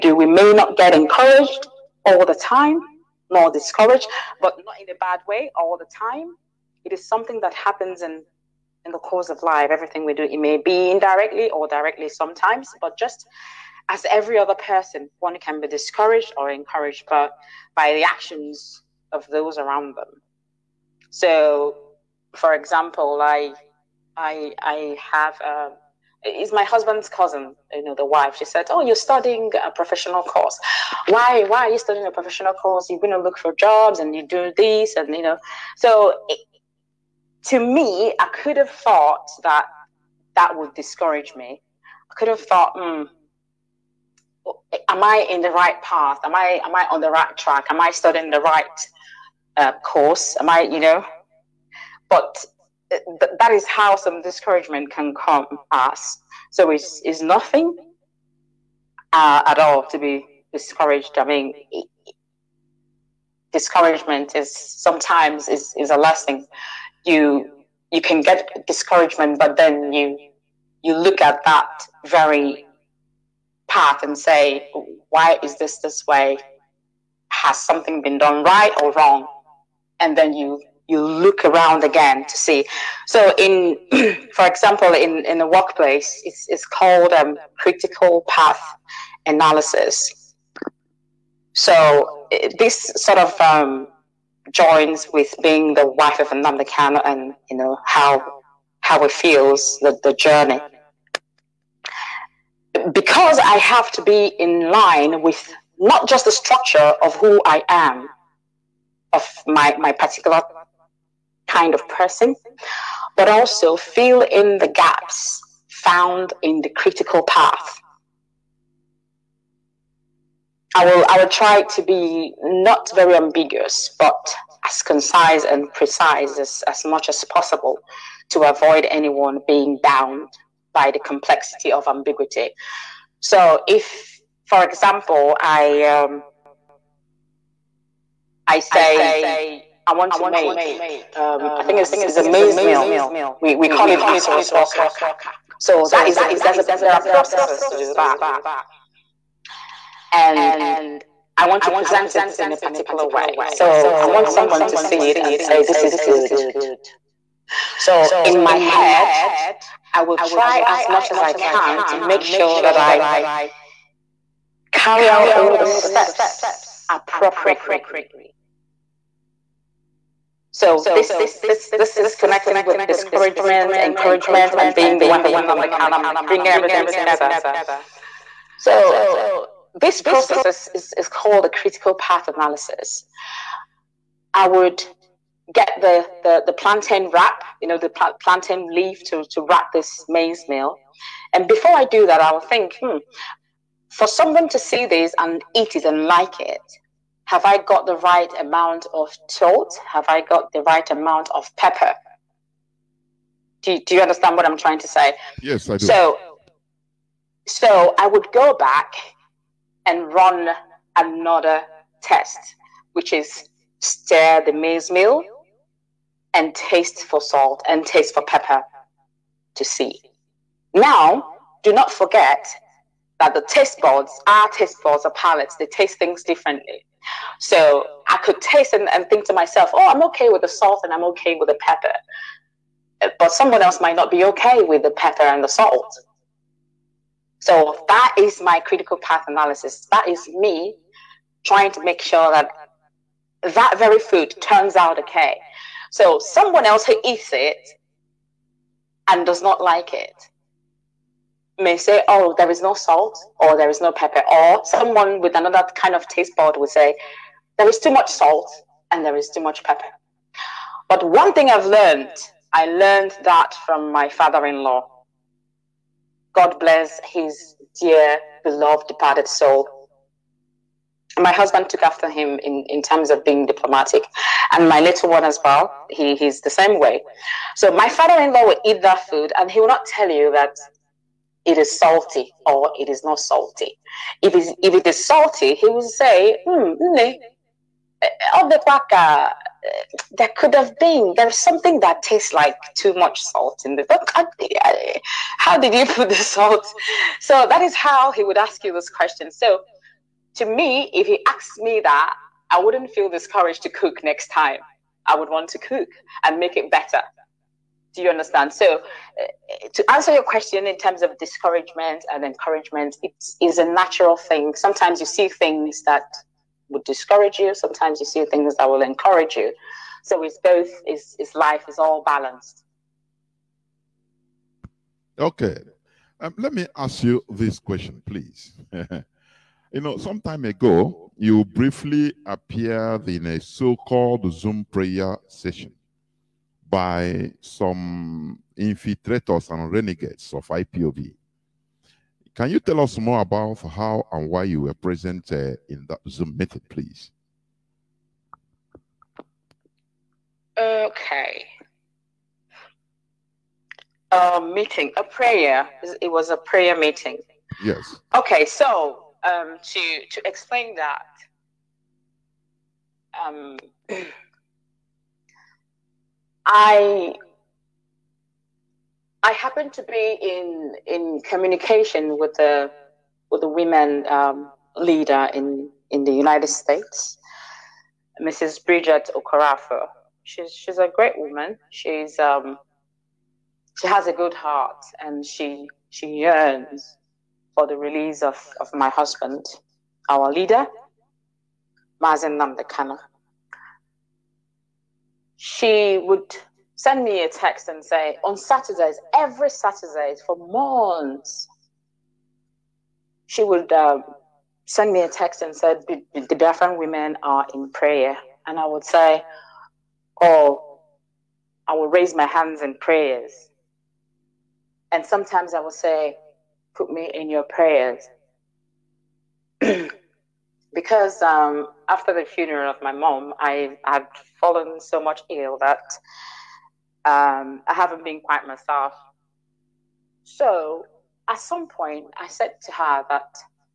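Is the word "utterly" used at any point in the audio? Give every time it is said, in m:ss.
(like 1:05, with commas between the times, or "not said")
not said.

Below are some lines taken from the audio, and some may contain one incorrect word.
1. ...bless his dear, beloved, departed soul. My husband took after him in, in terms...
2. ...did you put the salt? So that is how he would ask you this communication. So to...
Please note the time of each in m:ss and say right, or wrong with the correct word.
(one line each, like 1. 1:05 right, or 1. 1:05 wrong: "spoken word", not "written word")
1. 4:26 right
2. 4:55 wrong: "question", not "communication".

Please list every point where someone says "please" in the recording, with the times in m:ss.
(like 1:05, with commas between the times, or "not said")
5:28, 5:46.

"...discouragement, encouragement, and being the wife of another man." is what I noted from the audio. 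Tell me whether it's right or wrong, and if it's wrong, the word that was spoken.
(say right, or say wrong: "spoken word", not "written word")
right.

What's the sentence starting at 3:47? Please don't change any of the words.
So I could taste and, and think to myself, oh, I'm okay with the salt and I'm okay with the pepper.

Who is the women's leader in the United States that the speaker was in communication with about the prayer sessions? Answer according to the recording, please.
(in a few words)
Bridget Okorafor.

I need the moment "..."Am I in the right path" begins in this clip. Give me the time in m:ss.
0:44.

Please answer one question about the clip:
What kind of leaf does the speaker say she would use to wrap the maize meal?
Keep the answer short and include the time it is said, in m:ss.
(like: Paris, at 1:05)
Plantain leaf, at 3:08.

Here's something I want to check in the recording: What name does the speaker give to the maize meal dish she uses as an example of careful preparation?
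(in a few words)
Asaros.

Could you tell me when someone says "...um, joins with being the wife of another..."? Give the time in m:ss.
1:33.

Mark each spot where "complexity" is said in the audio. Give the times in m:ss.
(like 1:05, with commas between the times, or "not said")
2:10.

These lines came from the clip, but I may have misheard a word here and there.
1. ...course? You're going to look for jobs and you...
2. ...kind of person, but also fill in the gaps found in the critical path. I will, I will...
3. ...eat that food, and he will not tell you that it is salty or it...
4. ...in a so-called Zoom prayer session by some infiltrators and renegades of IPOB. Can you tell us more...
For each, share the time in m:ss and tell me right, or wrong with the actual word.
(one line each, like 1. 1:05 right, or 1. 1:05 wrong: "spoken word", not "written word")
1. 0:32 right
2. 1:51 right
3. 4:38 right
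4. 5:33 right.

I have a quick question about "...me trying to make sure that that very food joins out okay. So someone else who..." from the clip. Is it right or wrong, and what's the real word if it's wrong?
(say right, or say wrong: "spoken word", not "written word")
wrong: "turns", not "joins".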